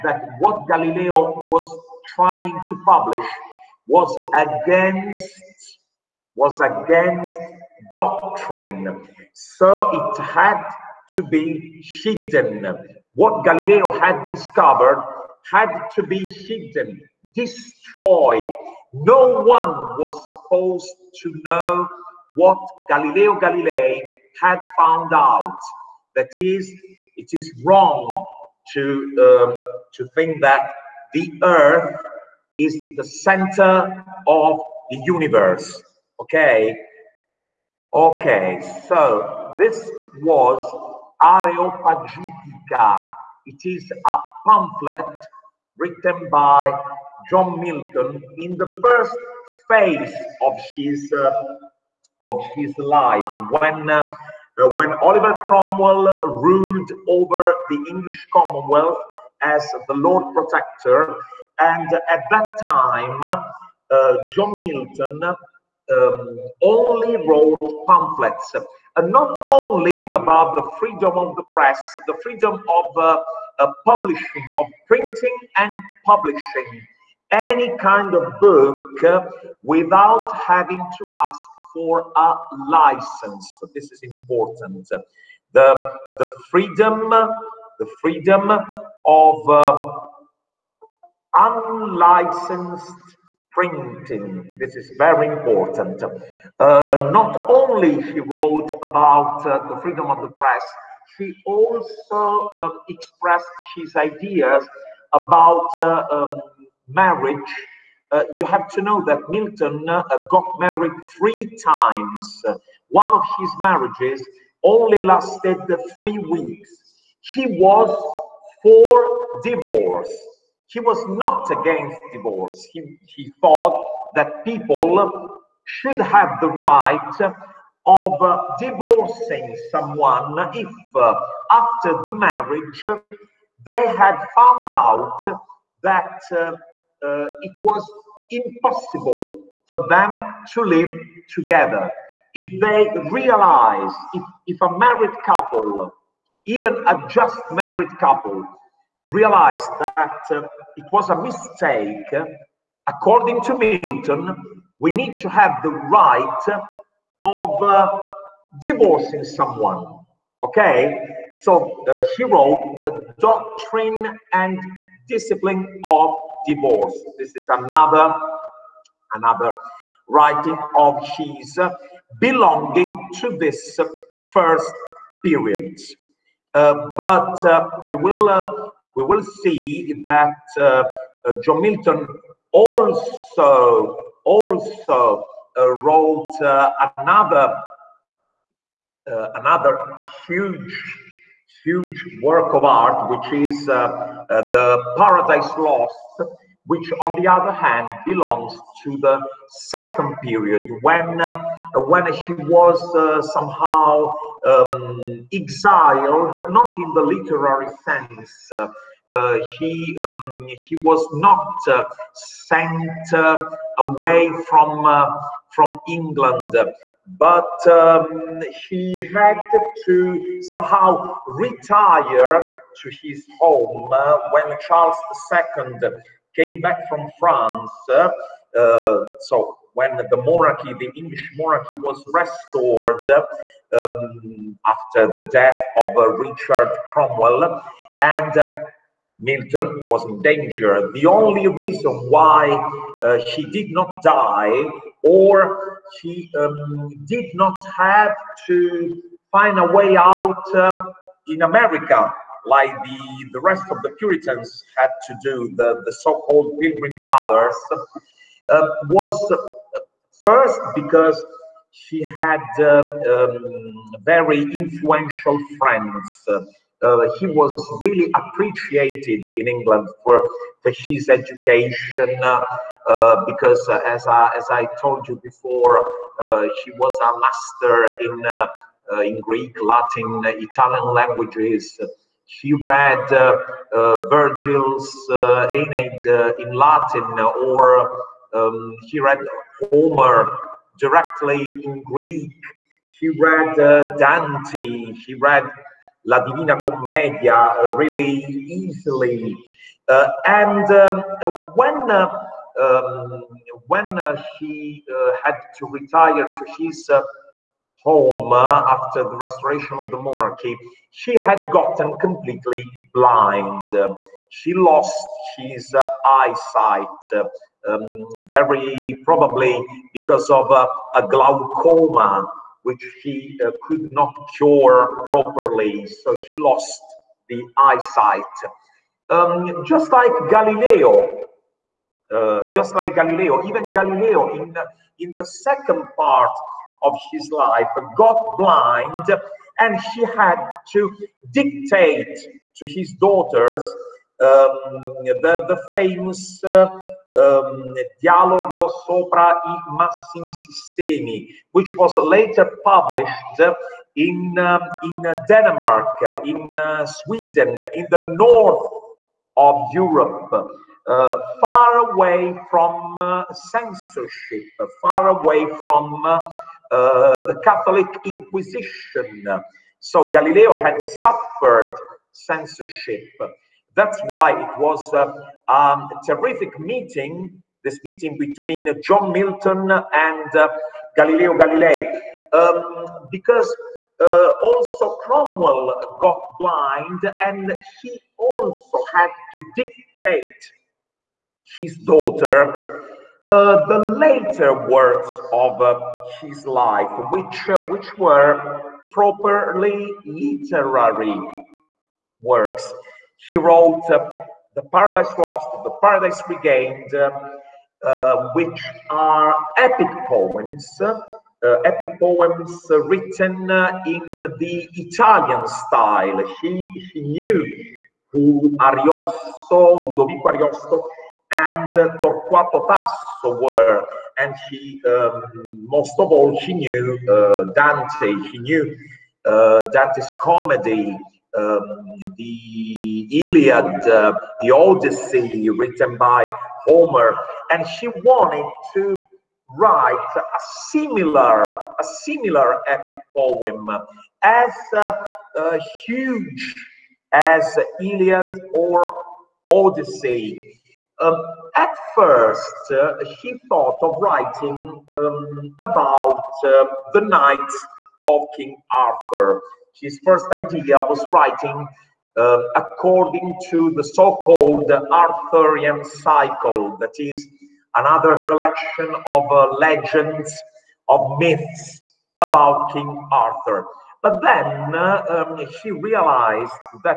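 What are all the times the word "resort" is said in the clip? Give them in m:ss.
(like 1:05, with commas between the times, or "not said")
not said.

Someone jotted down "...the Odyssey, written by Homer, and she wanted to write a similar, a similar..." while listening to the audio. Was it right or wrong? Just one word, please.
right.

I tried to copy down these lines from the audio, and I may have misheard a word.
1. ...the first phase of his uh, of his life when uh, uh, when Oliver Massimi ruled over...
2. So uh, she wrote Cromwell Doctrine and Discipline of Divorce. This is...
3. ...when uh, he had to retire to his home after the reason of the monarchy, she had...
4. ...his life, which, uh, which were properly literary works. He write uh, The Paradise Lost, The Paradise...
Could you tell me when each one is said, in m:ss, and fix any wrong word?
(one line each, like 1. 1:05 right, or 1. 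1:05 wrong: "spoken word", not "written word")
1. 0:48 wrong: "Cromwell", not "Massimi"
2. 2:41 wrong: "The", not "Cromwell"
3. 5:03 wrong: "restoration", not "reason"
4. 6:36 wrong: "wrote", not "write".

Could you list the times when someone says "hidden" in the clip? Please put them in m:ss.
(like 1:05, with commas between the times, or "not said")
0:12, 0:16.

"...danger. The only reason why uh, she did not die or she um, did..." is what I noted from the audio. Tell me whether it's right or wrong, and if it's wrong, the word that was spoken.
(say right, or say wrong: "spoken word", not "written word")
right.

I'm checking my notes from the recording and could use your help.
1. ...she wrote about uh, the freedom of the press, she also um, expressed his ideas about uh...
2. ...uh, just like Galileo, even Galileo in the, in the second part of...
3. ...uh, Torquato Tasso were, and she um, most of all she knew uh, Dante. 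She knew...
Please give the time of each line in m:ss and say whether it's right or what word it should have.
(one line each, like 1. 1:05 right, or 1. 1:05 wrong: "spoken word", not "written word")
1. 1:38 right
2. 5:32 right
3. 7:01 right.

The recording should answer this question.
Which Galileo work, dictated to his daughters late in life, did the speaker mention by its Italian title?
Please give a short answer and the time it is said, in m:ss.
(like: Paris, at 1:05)
Dialogo sopra i Massimi Sistemi, at 5:48.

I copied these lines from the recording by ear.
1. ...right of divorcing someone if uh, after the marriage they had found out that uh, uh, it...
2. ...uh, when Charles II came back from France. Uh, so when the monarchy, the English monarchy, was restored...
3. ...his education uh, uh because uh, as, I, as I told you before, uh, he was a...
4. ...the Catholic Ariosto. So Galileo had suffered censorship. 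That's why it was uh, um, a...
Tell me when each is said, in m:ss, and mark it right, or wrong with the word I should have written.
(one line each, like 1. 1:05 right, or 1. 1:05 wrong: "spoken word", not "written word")
1. 2:06 right
2. 3:43 right
3. 4:30 right
4. 6:07 wrong: "Inquisition", not "Ariosto".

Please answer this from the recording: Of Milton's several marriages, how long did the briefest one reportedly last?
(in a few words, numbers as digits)
3 weeks.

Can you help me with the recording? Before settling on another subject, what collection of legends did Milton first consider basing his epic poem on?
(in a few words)
Arthurian cycle.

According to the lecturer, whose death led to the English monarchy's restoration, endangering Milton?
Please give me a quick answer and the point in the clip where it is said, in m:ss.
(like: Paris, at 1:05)
Richard Cromwell, at 3:55.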